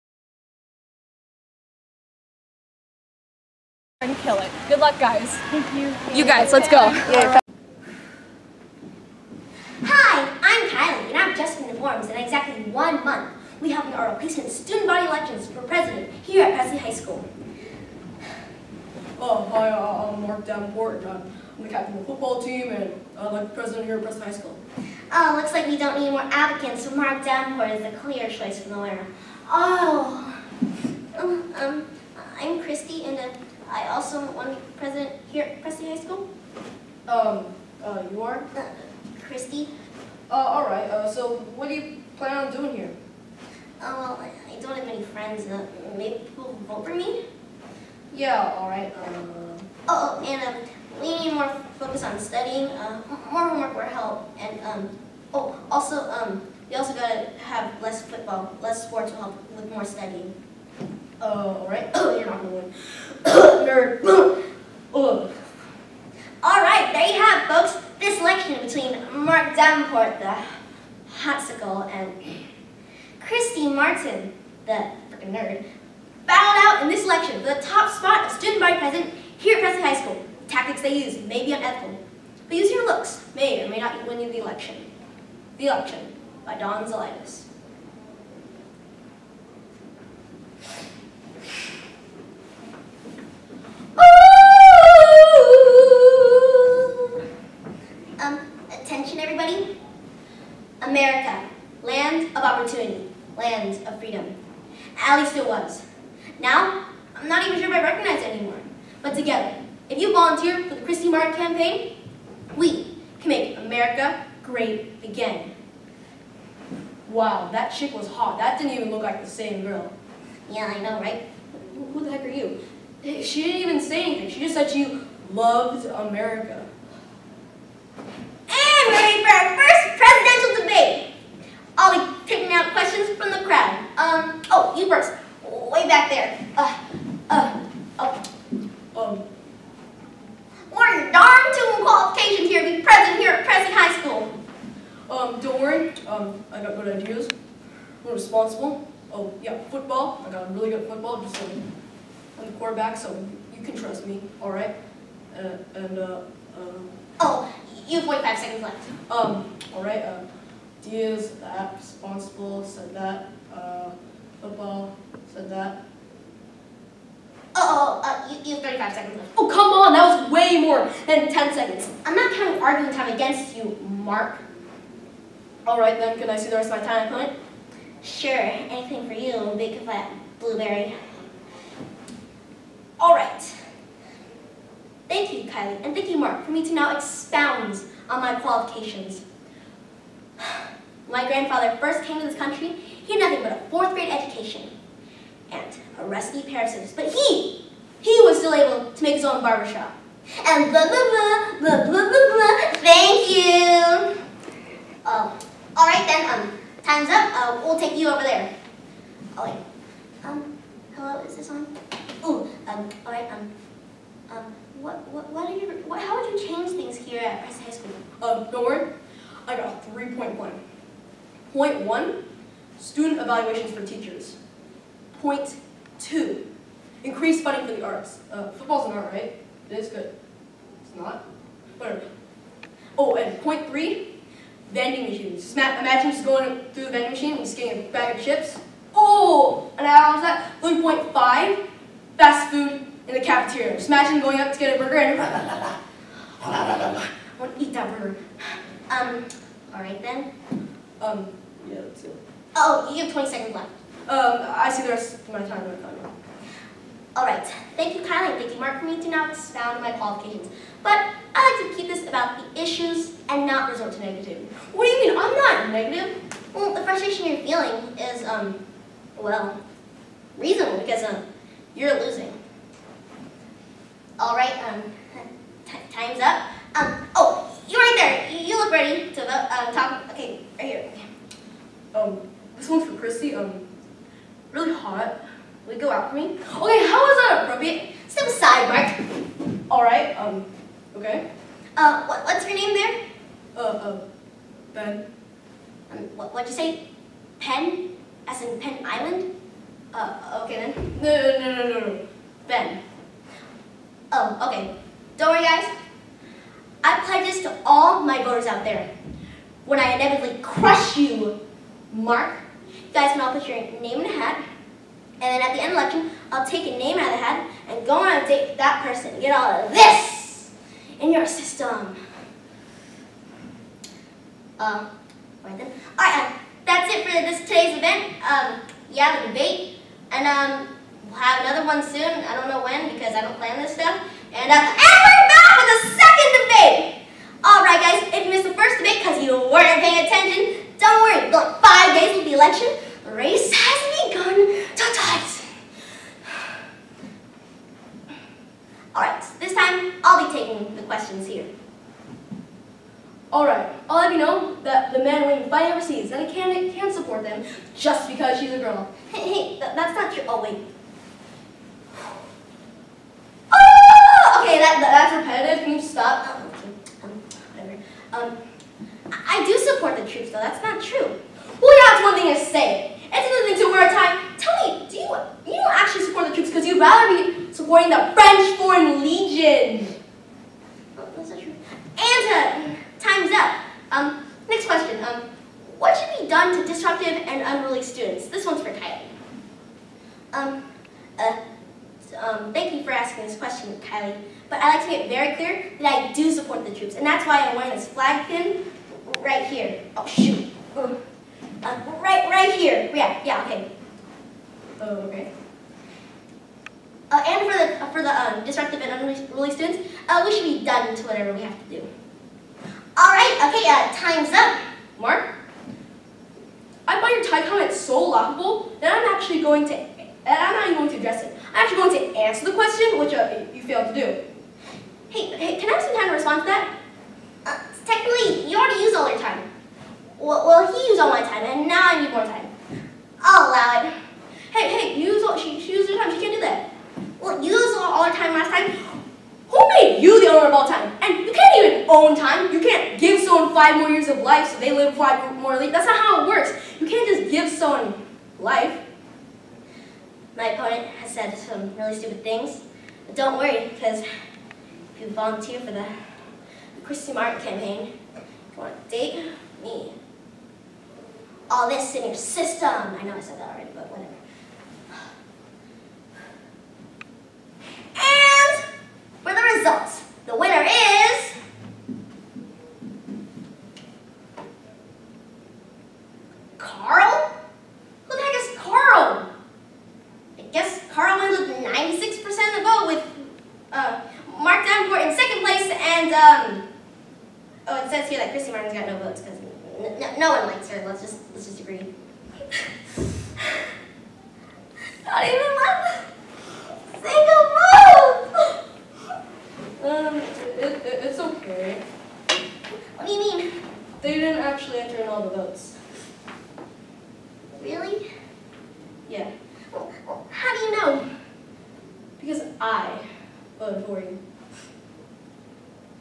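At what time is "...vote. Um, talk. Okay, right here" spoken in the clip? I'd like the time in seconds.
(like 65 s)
279 s.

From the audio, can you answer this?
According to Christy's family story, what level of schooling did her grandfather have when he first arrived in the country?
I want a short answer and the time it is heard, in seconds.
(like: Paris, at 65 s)
Fourth grade, at 193 s.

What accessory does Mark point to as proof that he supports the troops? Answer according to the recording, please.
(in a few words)
Flag pin.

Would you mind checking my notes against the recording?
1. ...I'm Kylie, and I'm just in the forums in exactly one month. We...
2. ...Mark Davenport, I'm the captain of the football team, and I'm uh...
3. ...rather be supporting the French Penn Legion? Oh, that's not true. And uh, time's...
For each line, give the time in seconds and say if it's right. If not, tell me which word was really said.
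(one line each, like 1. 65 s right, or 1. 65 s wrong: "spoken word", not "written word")
1. 10 s right
2. 20 s right
3. 376 s wrong: "Foreign", not "Penn".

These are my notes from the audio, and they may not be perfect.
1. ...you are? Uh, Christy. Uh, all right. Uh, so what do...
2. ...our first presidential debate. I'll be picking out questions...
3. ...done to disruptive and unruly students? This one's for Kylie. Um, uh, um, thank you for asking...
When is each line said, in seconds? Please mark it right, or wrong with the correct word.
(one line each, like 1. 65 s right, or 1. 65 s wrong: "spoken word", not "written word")
1. 38 s right
2. 129 s right
3. 386 s right.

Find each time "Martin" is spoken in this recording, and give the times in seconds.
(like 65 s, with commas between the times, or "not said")
73 s, 457 s.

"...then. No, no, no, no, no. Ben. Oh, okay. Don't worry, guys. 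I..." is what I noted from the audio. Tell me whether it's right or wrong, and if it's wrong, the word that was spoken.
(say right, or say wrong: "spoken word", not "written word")
right.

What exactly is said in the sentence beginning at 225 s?
Point two, increase funding for the arts.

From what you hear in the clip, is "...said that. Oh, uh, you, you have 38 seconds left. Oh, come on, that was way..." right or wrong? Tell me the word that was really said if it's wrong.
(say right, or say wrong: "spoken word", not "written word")
wrong: "35", not "38".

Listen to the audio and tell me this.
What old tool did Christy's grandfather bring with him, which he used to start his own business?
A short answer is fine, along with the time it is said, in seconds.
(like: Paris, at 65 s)
A rusty pair of scissors, at 196 s.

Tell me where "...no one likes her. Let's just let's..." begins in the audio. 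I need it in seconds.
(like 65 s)
490 s.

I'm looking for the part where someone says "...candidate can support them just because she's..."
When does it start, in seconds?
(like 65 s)
356 s.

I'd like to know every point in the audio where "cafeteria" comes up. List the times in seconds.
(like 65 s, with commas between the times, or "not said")
243 s.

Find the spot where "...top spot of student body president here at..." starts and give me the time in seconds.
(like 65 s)
77 s.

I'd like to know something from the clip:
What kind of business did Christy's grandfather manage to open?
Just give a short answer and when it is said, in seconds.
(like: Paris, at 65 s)
Barbershop, at 199 s.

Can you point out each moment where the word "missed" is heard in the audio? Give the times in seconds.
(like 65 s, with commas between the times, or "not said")
338 s.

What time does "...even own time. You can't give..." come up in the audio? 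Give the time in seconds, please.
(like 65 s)
441 s.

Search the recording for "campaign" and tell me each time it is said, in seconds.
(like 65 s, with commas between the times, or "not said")
111 s, 457 s.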